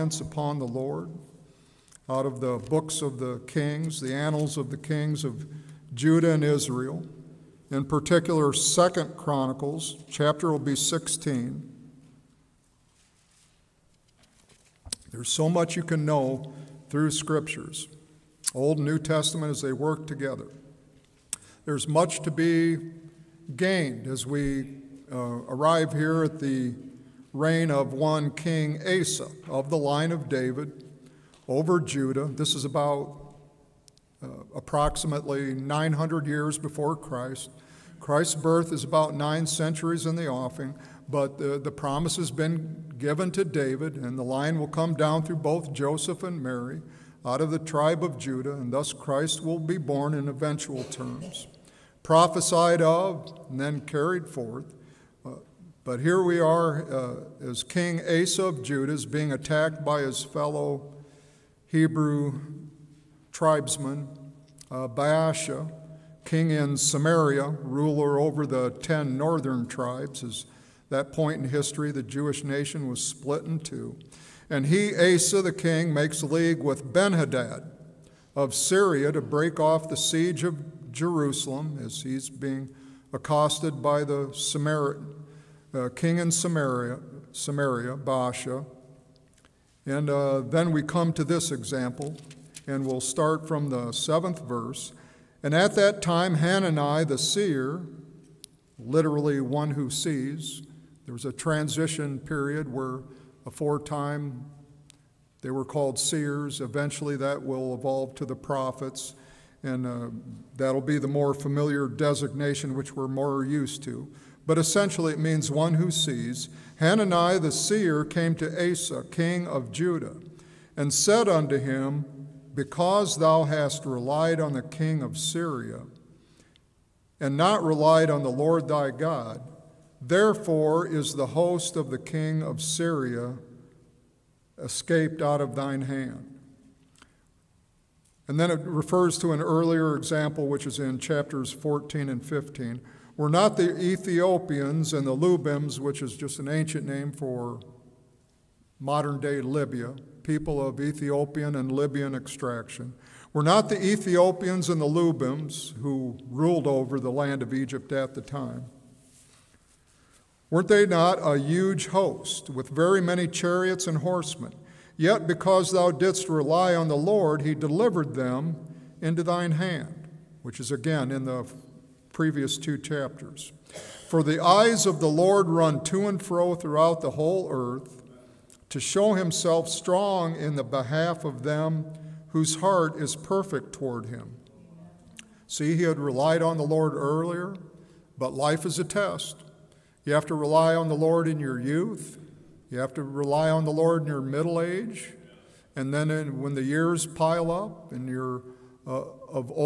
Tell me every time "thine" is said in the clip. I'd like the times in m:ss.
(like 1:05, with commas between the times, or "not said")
2:15, 2:49.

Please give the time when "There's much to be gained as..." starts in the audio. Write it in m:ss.
0:21.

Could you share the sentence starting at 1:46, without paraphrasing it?
Eventually, that will evolve to the prophets, and uh, that'll be the more familiar designation which we're more used to.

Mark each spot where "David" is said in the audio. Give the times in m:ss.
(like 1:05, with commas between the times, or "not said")
0:30, 0:43.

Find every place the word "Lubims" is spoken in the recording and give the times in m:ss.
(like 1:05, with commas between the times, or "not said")
2:25, 2:34.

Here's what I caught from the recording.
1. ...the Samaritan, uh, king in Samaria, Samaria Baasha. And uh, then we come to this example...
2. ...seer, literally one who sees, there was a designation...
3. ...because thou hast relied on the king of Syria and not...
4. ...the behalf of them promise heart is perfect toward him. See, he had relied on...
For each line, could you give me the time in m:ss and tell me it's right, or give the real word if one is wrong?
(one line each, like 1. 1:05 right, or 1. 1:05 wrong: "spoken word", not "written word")
1. 1:24 right
2. 1:37 wrong: "transition", not "designation"
3. 2:02 right
4. 3:00 wrong: "whose", not "promise".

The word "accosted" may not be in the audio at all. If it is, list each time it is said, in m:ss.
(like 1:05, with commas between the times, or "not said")
1:23.